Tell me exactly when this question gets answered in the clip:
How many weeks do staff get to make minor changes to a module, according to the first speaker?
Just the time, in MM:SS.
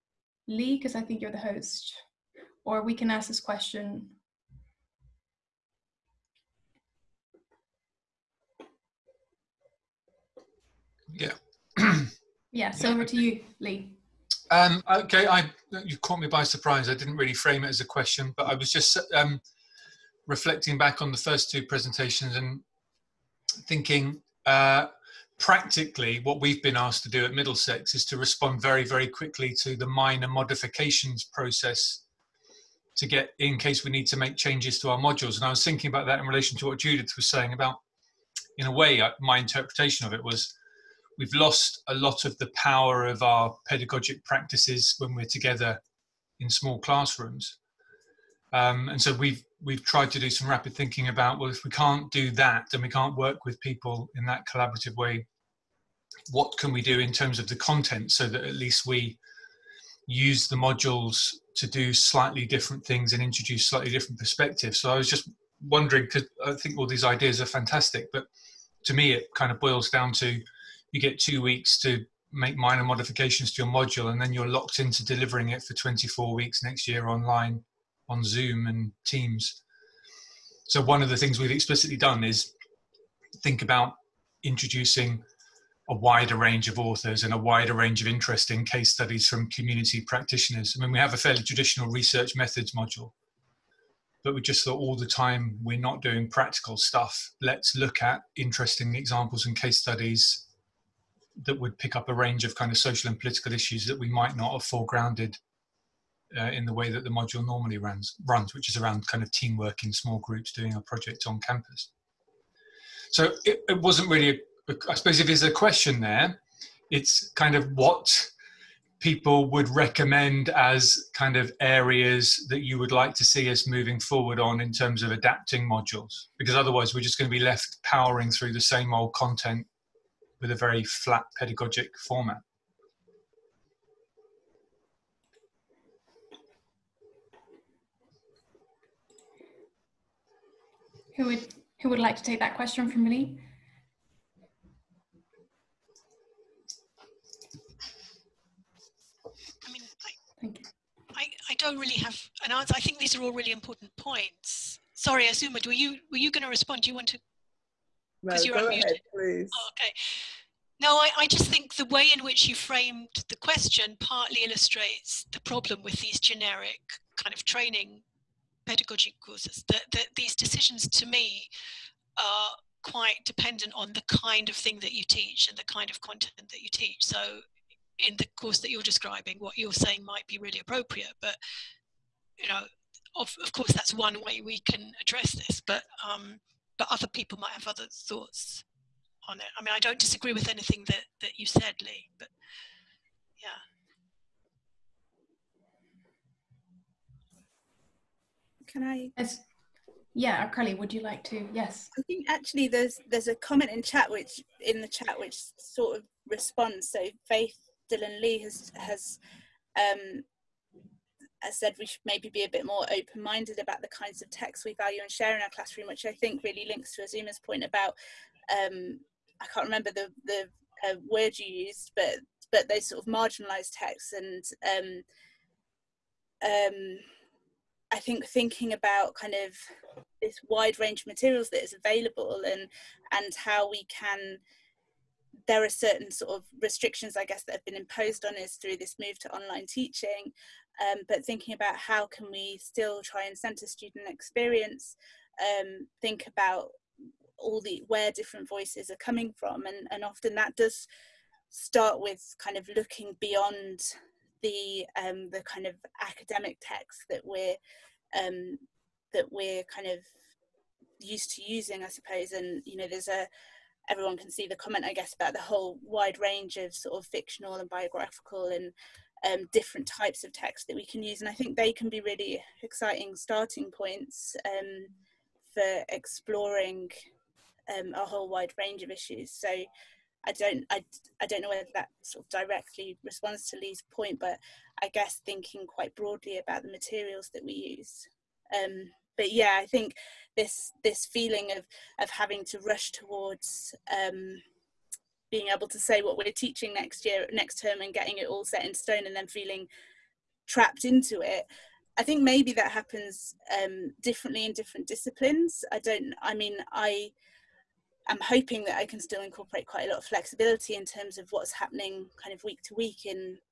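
01:11.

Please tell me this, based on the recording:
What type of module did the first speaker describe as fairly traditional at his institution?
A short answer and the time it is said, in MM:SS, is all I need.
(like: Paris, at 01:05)
research methods, at 01:31.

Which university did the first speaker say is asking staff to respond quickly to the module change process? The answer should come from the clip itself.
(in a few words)
Middlesex.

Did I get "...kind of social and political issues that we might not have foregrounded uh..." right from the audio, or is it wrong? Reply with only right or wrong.
right.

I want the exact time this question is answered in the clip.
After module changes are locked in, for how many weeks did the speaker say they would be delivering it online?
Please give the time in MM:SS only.
01:15.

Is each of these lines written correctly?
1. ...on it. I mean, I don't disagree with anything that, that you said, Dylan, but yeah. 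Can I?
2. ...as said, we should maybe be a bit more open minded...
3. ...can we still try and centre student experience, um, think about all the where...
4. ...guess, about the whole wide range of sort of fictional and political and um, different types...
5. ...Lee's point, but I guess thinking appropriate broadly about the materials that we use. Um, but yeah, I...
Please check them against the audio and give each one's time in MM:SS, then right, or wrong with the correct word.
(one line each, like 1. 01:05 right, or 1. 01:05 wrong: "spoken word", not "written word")
1. 03:09 wrong: "Lee", not "Dylan"
2. 03:31 right
3. 04:02 right
4. 04:24 wrong: "biographical", not "political"
5. 04:43 wrong: "quite", not "appropriate".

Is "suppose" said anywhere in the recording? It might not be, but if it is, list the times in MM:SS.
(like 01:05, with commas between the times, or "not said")
01:54, 04:21.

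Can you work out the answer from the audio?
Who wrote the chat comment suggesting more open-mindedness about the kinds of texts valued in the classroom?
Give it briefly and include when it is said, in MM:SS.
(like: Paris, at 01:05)
Faith Dylan Lee, at 03:27.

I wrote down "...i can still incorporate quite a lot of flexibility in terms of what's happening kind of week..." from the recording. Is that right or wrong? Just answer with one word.
right.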